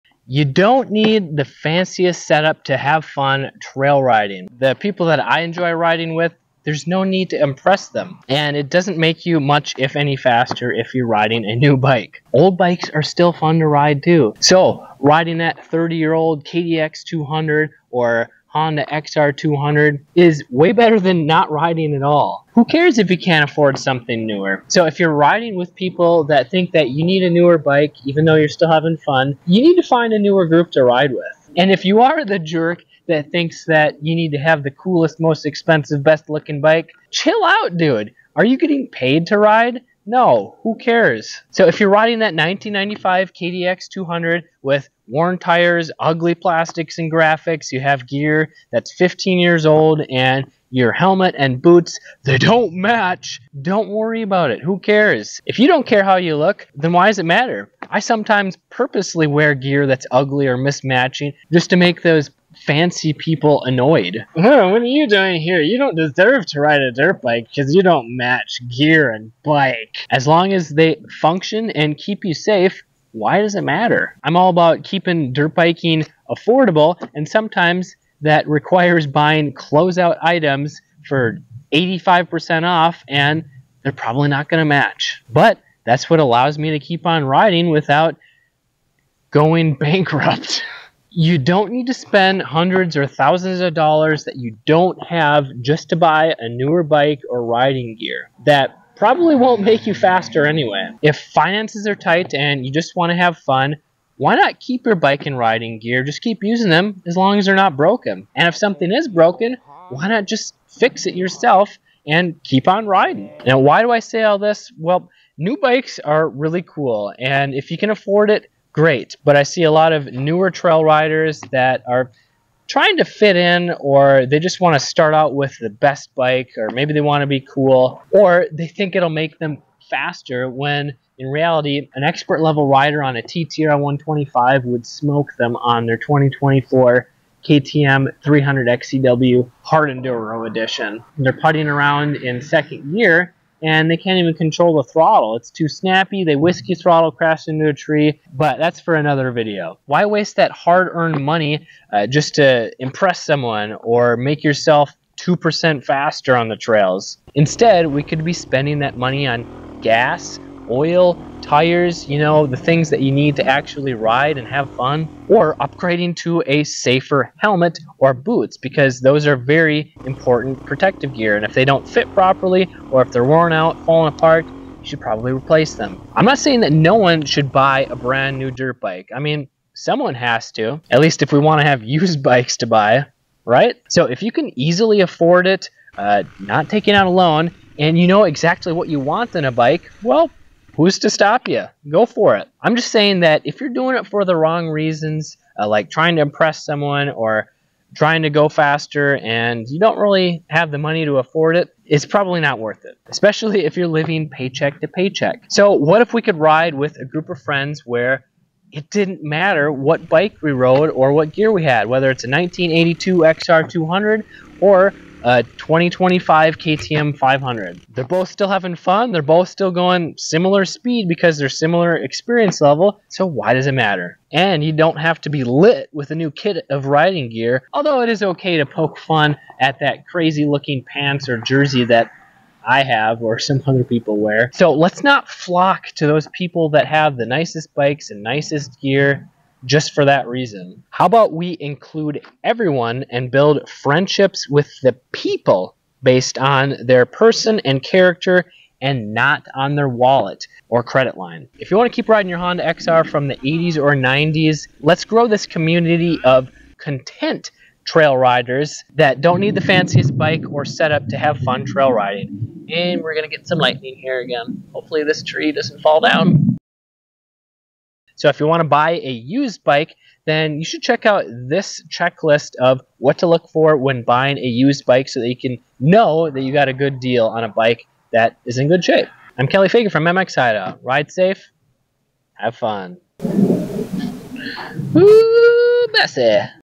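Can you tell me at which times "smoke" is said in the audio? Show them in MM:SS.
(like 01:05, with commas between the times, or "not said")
02:14.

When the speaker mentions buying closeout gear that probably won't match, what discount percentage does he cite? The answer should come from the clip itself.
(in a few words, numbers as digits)
85%.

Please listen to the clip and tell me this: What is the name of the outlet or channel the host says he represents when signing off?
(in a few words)
MX Hideout.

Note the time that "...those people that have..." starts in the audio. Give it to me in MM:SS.
03:56.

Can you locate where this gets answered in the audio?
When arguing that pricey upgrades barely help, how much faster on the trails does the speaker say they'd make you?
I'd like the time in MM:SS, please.
02:35.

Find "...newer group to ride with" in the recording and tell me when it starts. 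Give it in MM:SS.
00:30.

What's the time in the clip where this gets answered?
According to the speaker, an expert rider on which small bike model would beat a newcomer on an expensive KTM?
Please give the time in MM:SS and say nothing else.
02:13.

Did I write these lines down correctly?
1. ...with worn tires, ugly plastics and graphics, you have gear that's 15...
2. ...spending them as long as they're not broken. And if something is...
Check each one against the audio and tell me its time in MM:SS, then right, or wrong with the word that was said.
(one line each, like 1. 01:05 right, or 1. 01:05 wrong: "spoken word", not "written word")
1. 00:44 right
2. 01:46 wrong: "using", not "spending".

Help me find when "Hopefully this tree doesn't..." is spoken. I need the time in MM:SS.
04:24.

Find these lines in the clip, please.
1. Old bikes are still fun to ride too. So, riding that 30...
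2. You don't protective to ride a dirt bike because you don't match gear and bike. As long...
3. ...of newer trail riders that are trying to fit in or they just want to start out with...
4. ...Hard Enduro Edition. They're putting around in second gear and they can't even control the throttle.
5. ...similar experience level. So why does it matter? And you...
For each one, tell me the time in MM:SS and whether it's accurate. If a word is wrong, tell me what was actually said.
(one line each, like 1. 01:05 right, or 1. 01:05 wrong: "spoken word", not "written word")
1. 00:12 right
2. 01:05 wrong: "deserve", not "protective"
3. 01:59 right
4. 02:19 right
5. 03:41 right.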